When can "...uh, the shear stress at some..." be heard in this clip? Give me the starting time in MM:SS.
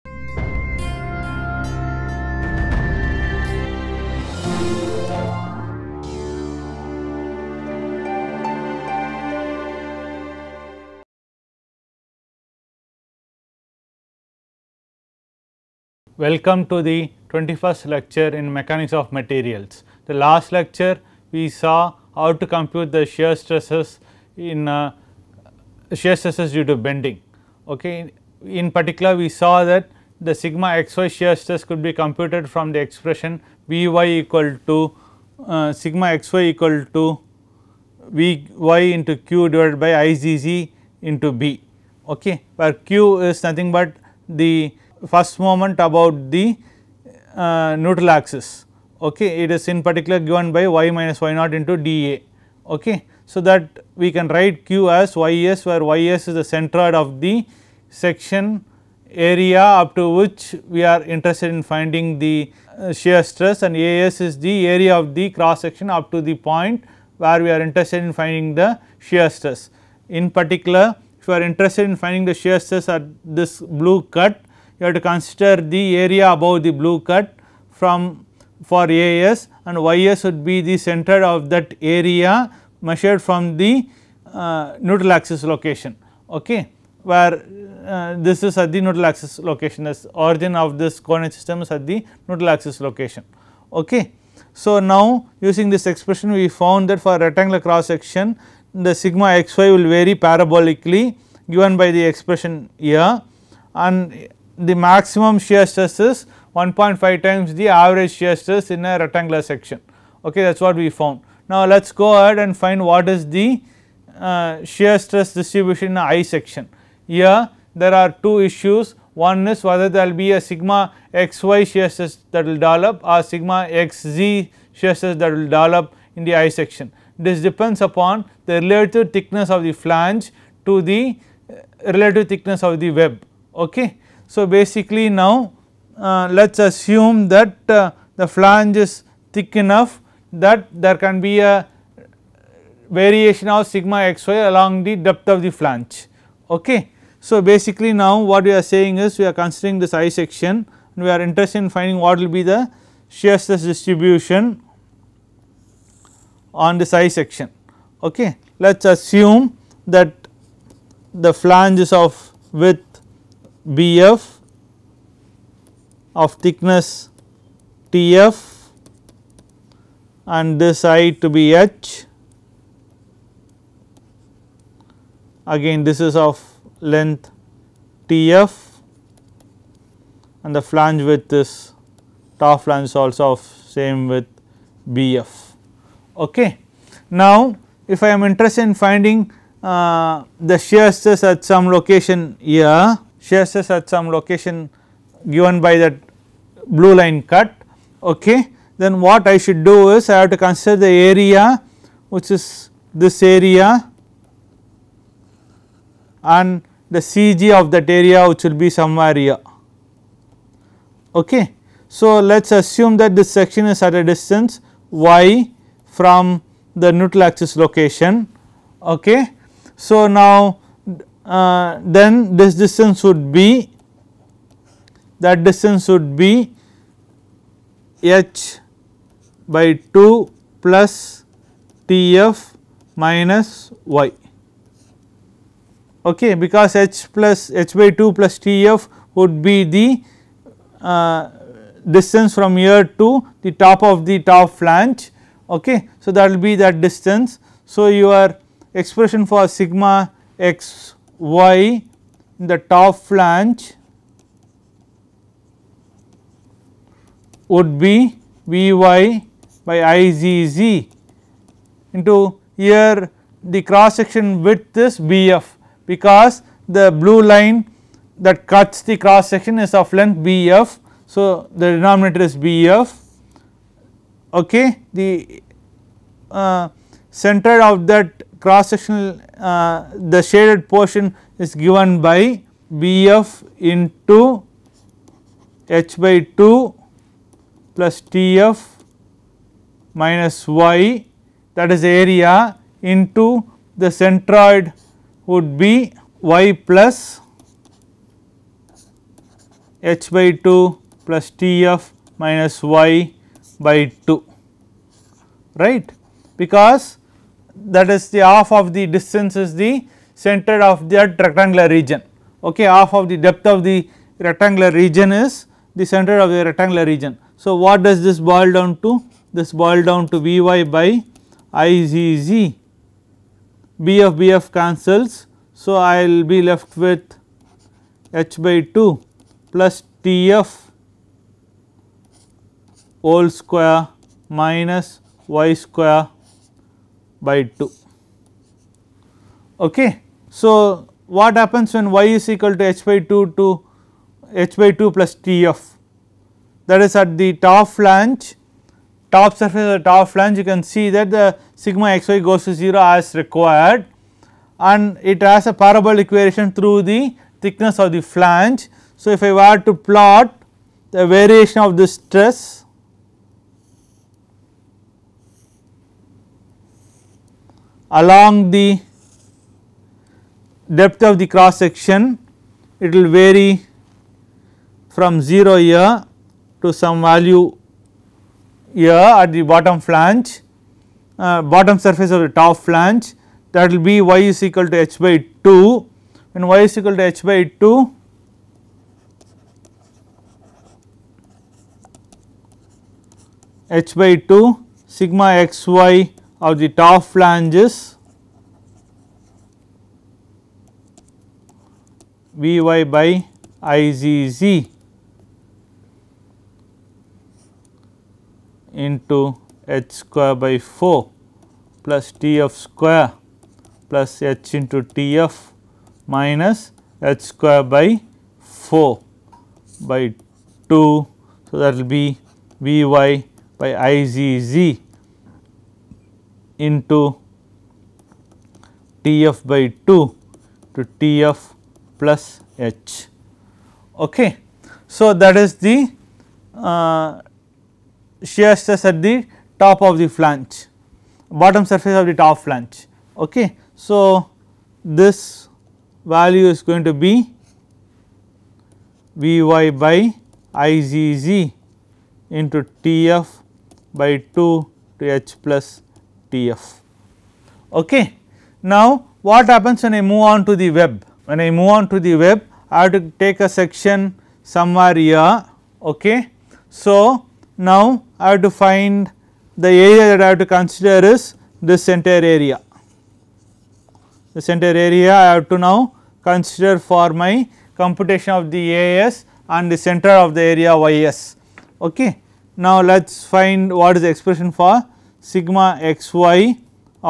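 03:09.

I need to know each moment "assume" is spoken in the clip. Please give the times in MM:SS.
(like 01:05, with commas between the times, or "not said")
02:16, 02:39, 03:32.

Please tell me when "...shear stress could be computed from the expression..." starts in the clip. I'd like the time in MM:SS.
00:31.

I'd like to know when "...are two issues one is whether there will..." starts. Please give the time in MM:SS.
01:57.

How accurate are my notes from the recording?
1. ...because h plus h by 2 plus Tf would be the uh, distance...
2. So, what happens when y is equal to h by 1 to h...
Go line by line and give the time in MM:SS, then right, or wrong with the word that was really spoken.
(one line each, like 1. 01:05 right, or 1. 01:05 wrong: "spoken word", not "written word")
1. 03:56 right
2. 05:40 wrong: "2", not "1".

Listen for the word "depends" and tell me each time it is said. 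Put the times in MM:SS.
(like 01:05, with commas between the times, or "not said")
02:07.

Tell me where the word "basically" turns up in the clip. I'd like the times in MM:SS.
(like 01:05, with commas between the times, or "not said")
02:14, 02:27.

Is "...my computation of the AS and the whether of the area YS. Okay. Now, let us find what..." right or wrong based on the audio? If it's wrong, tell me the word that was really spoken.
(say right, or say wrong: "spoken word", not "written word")
wrong: "center", not "whether".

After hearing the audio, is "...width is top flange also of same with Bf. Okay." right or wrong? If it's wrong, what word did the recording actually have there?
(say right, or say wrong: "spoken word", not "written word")
right.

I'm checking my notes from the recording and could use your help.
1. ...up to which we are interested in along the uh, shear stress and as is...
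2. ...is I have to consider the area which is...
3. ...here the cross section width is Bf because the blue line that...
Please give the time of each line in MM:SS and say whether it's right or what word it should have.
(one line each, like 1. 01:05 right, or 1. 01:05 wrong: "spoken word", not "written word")
1. 00:59 wrong: "finding", not "along"
2. 03:19 right
3. 04:22 right.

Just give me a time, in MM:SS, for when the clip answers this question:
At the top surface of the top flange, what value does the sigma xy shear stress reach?
05:52.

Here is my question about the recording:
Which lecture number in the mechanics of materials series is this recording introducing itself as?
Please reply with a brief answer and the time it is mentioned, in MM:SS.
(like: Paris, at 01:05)
21st, at 00:17.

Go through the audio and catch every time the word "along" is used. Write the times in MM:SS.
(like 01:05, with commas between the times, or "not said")
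02:24, 06:07.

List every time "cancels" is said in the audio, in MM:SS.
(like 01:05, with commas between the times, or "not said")
05:24.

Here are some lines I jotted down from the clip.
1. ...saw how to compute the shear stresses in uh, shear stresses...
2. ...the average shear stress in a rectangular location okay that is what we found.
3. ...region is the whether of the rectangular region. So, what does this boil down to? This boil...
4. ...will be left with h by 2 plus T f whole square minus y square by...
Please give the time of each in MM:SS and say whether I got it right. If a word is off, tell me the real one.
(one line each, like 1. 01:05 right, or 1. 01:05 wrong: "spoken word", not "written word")
1. 00:21 right
2. 01:47 wrong: "section", not "location"
3. 05:14 wrong: "center", not "whether"
4. 05:26 right.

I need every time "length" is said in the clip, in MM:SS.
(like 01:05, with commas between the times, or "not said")
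02:56, 04:29.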